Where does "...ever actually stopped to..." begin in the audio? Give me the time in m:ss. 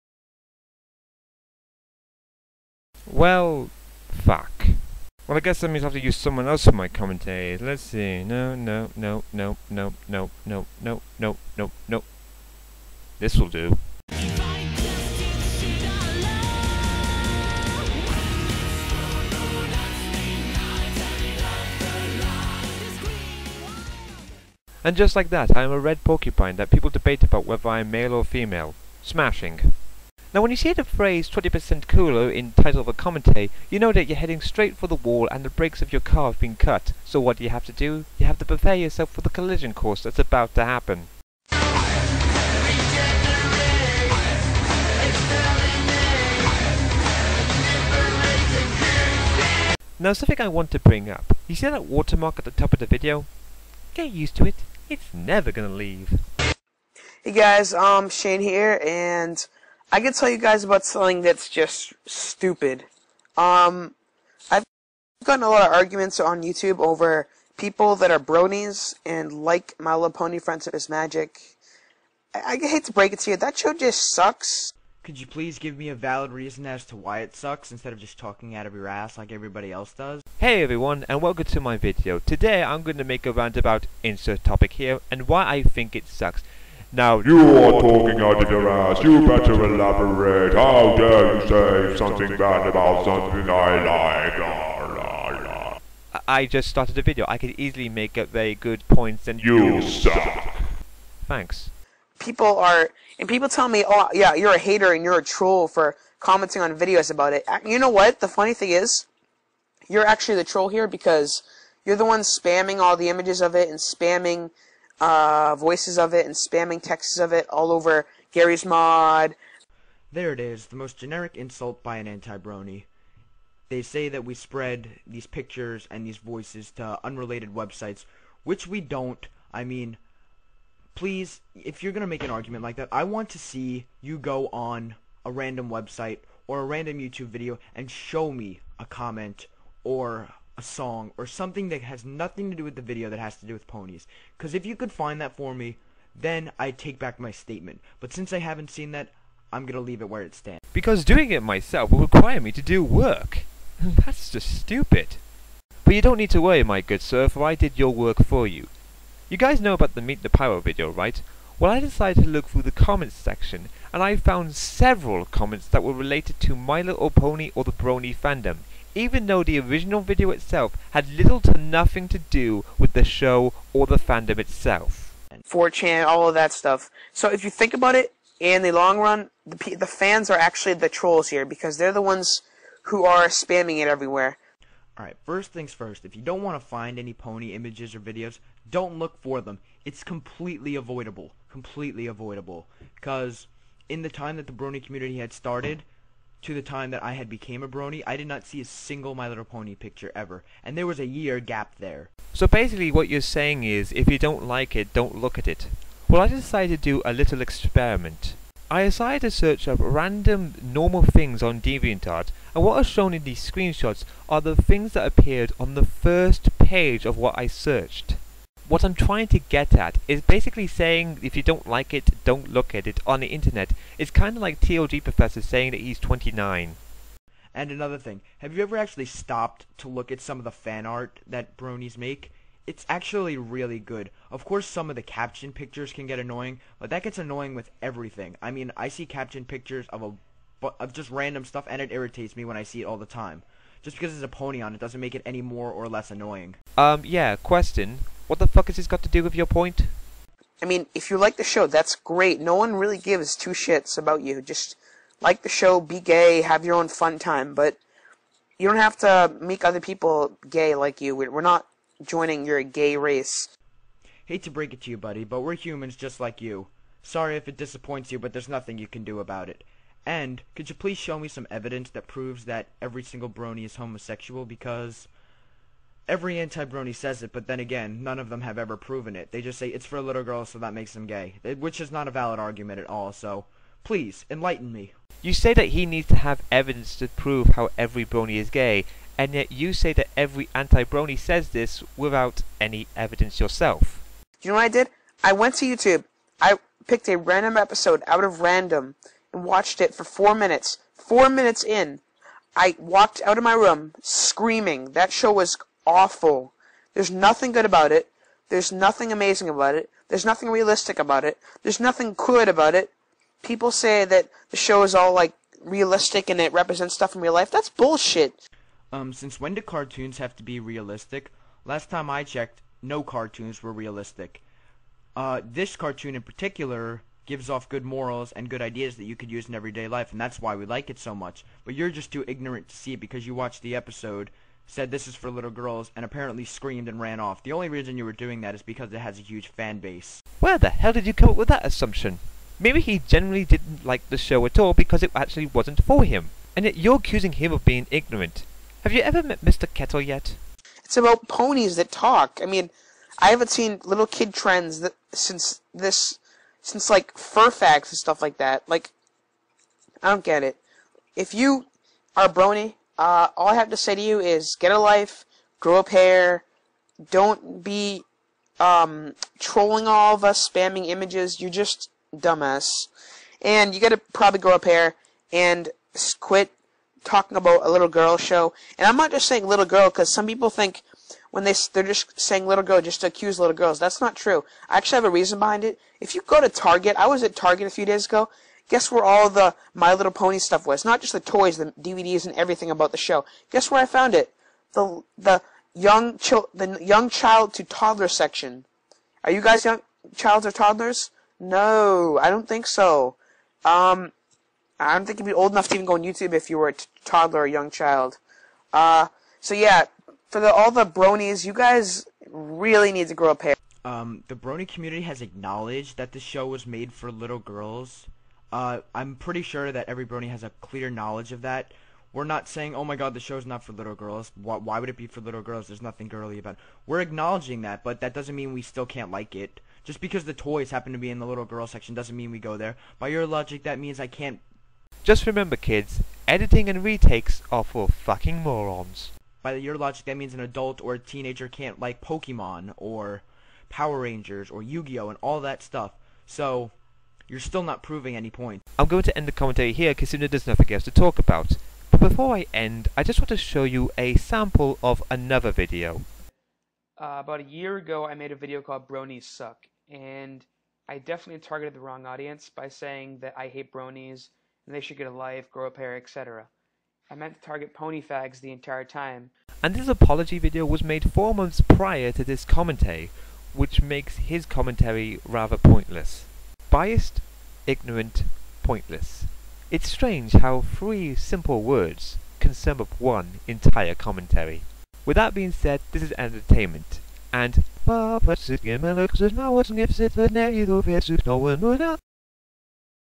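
3:48.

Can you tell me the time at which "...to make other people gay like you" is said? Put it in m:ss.
4:18.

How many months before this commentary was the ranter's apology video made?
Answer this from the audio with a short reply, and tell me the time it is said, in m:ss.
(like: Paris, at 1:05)
4, at 7:51.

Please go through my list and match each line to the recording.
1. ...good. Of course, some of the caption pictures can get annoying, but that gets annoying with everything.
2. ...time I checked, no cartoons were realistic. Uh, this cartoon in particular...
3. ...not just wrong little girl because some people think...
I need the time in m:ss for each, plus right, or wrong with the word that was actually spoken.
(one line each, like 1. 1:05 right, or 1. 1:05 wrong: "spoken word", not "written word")
1. 3:53 right
2. 5:21 right
3. 6:18 wrong: "saying", not "wrong".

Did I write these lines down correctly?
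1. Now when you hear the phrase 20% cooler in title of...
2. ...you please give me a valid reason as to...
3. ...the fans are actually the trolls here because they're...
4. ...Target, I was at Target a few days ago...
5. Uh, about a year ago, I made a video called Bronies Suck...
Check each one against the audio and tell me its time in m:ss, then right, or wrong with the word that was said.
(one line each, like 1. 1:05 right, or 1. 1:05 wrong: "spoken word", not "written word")
1. 0:30 right
2. 1:15 right
3. 2:59 right
4. 6:26 right
5. 7:37 right.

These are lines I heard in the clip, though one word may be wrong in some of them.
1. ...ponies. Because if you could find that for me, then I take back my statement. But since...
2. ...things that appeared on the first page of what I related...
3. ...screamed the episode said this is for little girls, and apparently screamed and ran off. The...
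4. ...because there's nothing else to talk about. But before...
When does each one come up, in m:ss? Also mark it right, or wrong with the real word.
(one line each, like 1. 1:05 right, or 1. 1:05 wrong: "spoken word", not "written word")
1. 2:23 right
2. 3:34 wrong: "searched", not "related"
3. 5:33 wrong: "watched", not "screamed"
4. 7:29 right.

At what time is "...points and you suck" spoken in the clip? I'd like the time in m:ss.
1:38.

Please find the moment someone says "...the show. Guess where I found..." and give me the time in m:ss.
6:32.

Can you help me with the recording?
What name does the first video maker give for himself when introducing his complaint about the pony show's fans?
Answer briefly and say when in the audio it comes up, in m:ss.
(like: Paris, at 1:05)
Shane, at 0:58.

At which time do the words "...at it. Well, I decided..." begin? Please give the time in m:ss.
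3:25.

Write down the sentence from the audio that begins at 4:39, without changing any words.
They just say it's for little girls, so that makes them gay, which is not a valid argument at all.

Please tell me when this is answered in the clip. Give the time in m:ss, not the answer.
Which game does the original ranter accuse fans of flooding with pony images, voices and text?
1:58.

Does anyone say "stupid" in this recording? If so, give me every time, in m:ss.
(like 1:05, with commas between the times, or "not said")
1:02, 2:34.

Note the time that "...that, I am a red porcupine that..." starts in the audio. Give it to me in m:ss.
0:25.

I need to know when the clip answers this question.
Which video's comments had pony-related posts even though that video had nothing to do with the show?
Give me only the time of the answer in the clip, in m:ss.
2:40.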